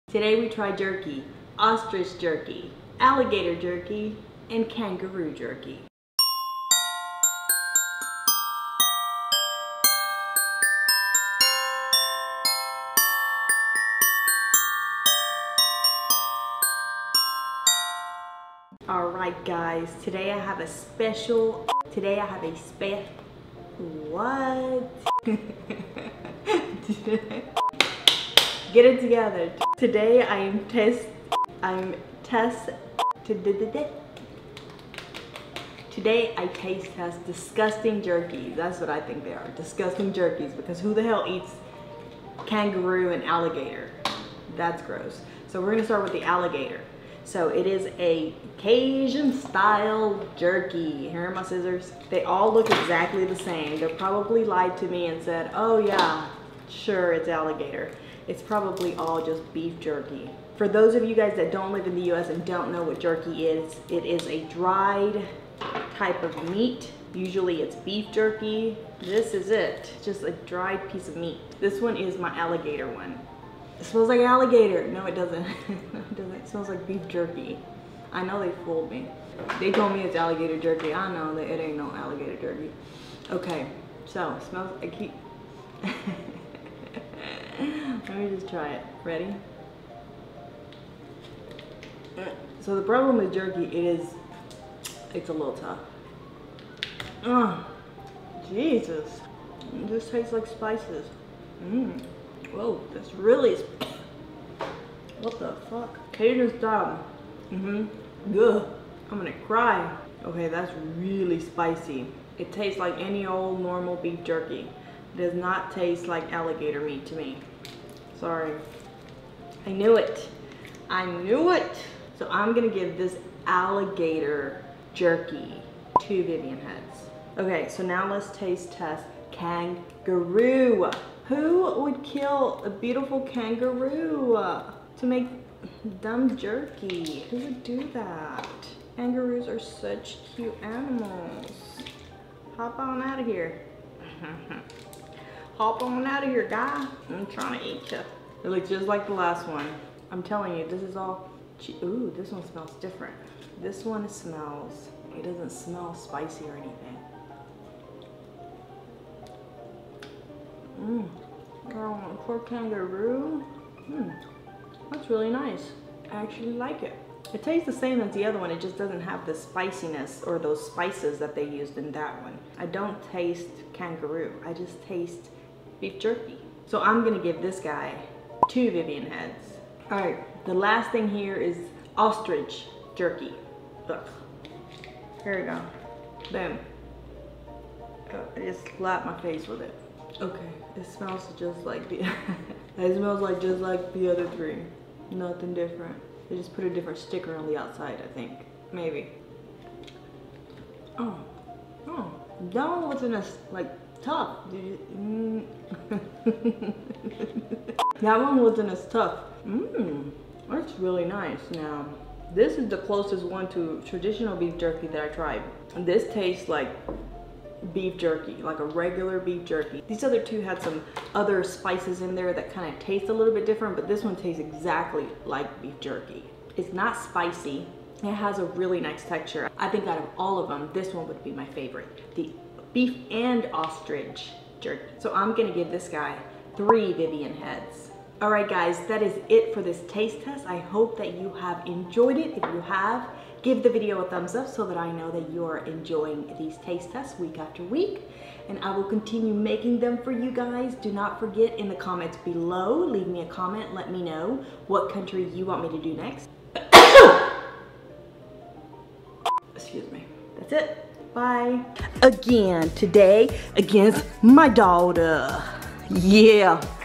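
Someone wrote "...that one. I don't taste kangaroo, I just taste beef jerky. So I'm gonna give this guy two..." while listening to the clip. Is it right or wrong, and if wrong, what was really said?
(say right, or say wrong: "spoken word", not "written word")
right.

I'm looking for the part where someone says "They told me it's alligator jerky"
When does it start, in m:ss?
1:19.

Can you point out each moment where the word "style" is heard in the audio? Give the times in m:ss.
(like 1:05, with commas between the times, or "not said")
0:49, 1:46.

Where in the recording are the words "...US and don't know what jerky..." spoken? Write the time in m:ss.
1:02.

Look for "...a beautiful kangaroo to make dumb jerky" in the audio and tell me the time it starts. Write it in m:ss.
2:12.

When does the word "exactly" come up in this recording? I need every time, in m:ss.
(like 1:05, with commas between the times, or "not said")
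0:52, 3:44.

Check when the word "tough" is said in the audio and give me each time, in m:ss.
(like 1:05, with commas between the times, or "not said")
1:35, 3:24, 3:28.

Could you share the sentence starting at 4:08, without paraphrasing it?
And I will continue making them for you guys.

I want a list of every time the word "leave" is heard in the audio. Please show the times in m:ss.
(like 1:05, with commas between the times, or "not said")
4:12.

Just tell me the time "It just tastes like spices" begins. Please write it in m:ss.
1:39.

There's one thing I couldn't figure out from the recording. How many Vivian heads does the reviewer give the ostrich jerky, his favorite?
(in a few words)
3.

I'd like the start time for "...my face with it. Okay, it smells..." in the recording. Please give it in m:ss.
3:09.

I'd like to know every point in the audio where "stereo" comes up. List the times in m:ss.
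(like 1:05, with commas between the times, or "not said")
not said.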